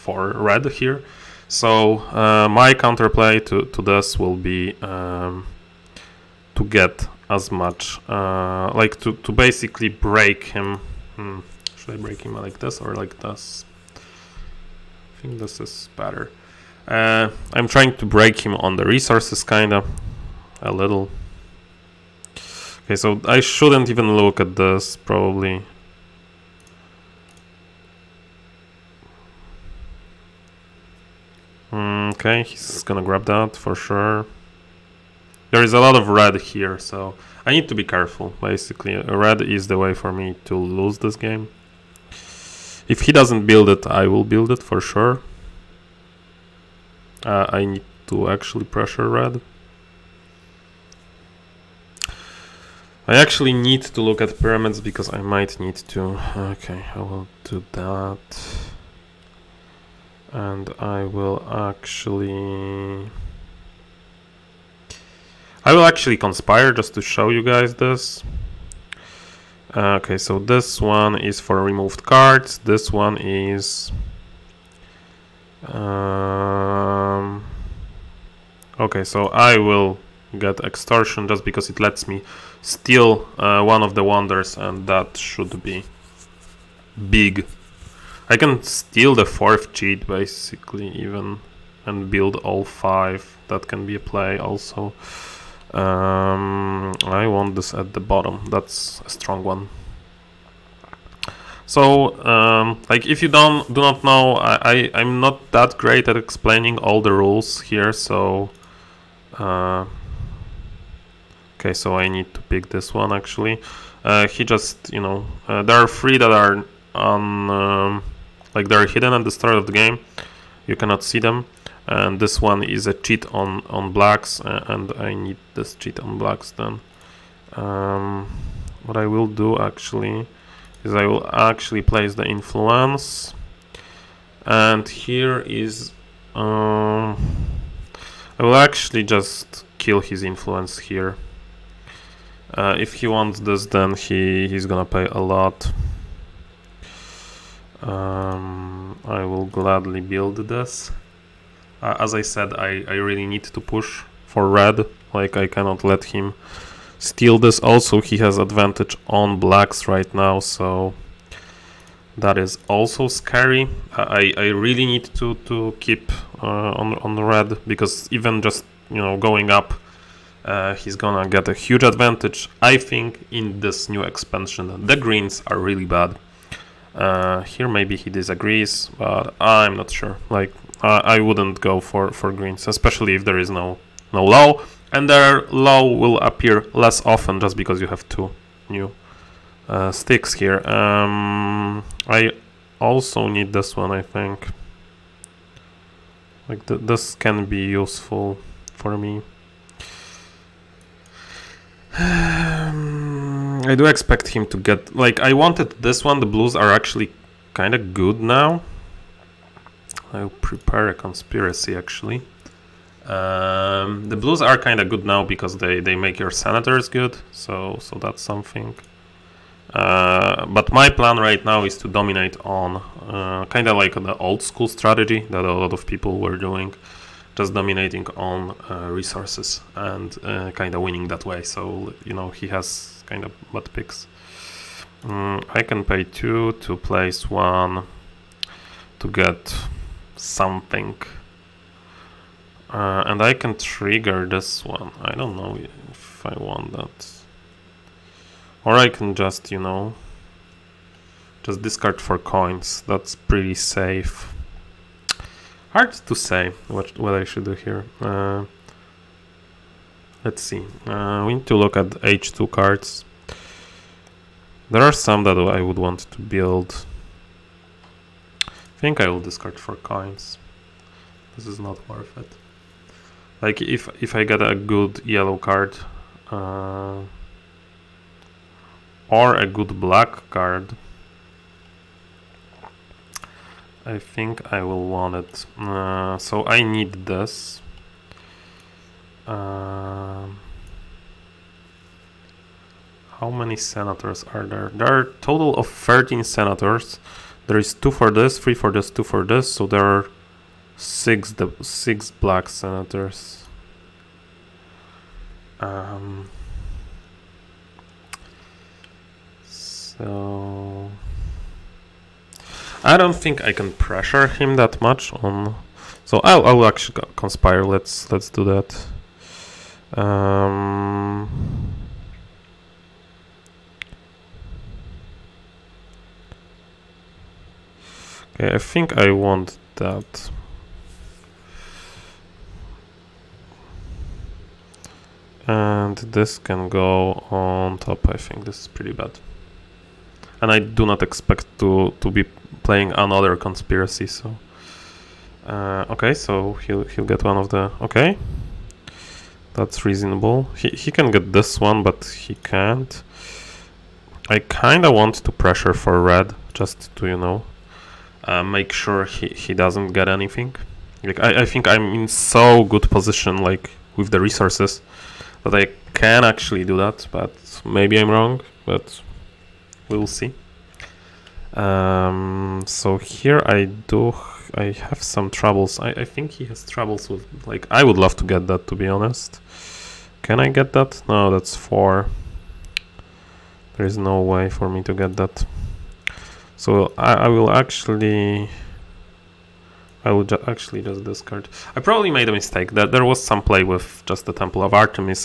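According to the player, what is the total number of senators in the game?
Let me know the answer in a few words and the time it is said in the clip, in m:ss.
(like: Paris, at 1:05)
13, at 4:55.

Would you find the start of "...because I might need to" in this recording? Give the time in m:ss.
0:54.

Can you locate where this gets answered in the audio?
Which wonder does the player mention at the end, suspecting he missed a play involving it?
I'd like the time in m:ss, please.
6:34.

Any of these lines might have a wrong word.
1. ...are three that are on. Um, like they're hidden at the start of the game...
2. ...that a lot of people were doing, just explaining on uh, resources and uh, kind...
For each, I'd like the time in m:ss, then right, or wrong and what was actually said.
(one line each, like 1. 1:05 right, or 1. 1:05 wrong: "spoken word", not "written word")
1. 1:55 right
2. 3:45 wrong: "dominating", not "explaining".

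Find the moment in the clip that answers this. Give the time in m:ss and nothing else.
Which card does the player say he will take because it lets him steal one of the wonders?
1:20.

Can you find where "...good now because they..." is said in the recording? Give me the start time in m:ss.
3:34.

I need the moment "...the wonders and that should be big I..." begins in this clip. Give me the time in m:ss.
1:23.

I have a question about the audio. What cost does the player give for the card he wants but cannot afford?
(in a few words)
4.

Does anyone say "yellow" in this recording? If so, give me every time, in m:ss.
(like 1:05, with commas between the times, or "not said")
4:35.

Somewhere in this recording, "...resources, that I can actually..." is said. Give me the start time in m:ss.
6:04.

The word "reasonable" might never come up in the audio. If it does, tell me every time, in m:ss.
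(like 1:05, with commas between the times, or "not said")
5:49.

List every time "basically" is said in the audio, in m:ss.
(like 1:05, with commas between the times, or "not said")
0:09, 0:38, 1:30.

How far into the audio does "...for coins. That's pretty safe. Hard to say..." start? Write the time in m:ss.
4:11.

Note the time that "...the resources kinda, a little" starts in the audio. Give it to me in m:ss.
0:18.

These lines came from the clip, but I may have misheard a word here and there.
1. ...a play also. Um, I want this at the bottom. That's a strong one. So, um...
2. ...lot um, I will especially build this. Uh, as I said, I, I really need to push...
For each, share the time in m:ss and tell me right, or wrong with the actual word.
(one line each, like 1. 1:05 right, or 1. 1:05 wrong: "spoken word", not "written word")
1. 1:33 right
2. 2:25 wrong: "gladly", not "especially".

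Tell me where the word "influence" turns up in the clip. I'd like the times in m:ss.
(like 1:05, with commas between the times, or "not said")
2:12, 2:20.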